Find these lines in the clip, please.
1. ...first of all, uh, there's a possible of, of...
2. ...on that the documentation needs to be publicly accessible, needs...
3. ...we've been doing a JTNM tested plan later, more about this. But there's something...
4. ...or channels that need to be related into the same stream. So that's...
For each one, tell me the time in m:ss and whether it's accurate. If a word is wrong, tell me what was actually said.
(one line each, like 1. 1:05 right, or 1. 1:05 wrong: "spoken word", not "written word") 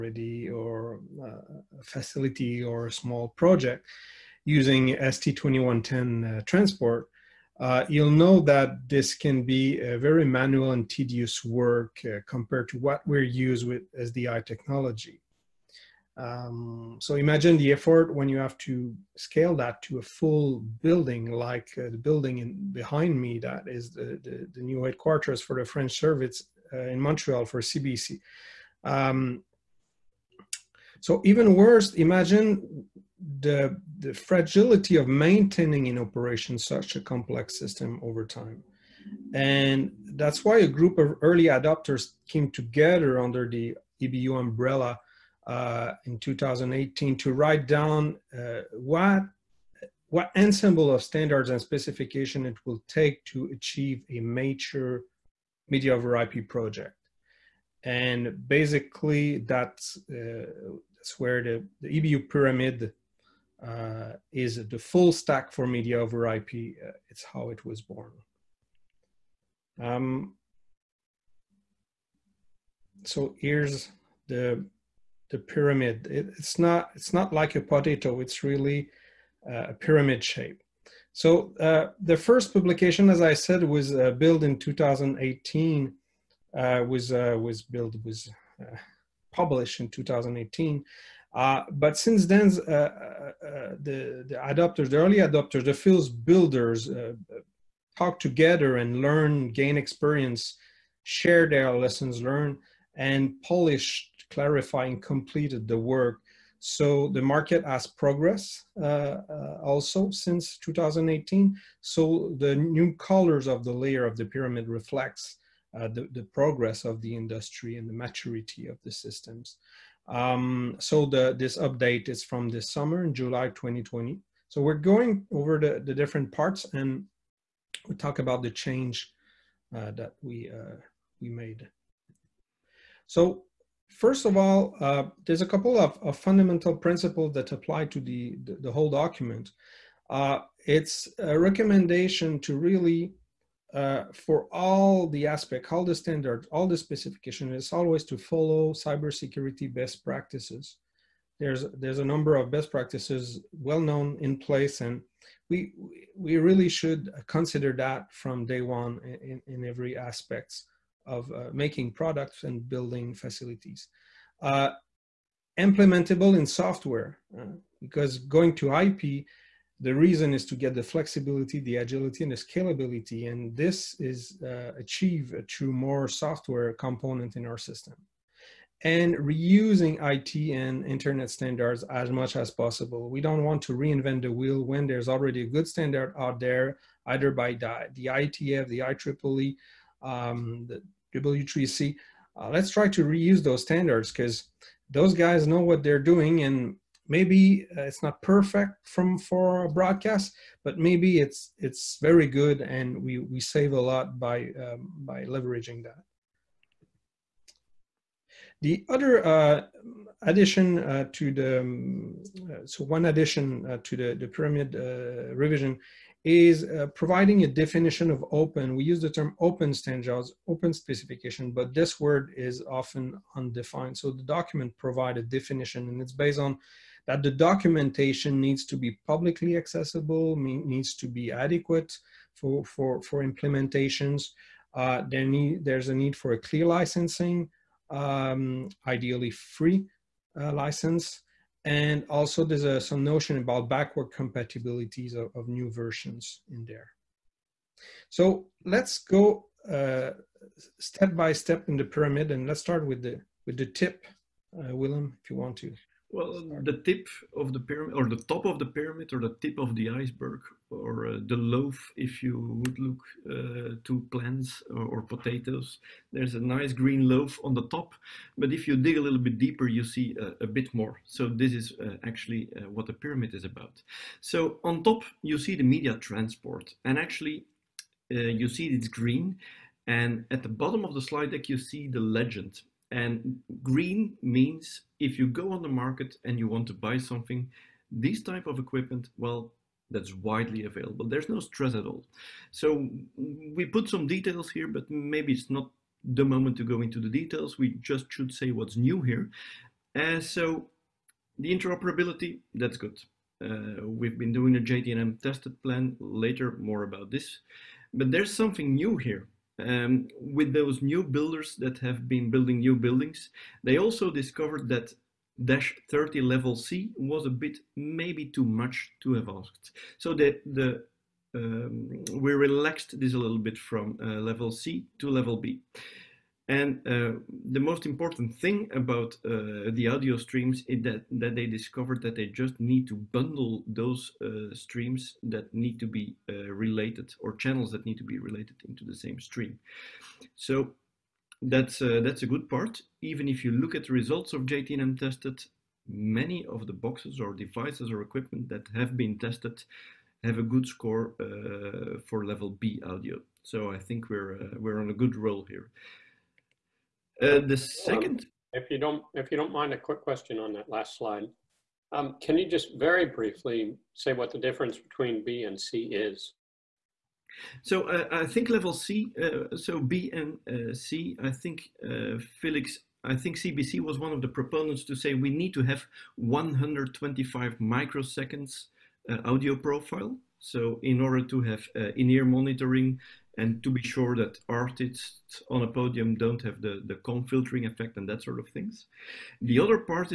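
1. 2:13 wrong: "couple", not "possible"
2. 3:46 right
3. 5:03 right
4. 5:37 right.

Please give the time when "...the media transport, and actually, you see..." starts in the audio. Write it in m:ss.
4:35.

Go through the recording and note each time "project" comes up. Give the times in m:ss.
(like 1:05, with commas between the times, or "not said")
0:03, 0:56.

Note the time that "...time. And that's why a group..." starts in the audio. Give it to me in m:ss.
0:38.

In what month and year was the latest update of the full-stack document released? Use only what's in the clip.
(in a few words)
July 2020.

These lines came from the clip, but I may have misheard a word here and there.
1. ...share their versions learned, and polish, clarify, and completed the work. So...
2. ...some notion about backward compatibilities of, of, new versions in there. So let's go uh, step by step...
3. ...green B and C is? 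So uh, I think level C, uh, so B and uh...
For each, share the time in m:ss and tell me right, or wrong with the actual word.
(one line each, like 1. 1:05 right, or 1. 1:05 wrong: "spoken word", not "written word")
1. 1:41 wrong: "lessons", not "versions"
2. 4:02 right
3. 6:04 wrong: "between", not "green".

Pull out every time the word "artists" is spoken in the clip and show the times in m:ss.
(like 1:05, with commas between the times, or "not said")
6:24.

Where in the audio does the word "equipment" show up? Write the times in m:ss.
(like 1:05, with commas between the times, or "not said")
4:48, 5:48.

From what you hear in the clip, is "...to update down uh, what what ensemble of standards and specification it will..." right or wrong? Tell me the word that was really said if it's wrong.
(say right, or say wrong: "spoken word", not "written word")
wrong: "write", not "update".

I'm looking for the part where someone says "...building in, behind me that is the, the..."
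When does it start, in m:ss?
0:21.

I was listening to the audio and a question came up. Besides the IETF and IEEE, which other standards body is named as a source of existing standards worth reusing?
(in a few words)
W3C.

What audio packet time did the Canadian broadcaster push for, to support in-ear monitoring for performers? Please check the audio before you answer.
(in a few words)
125 microseconds.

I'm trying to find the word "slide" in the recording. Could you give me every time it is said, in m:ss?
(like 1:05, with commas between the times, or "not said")
4:41, 6:00.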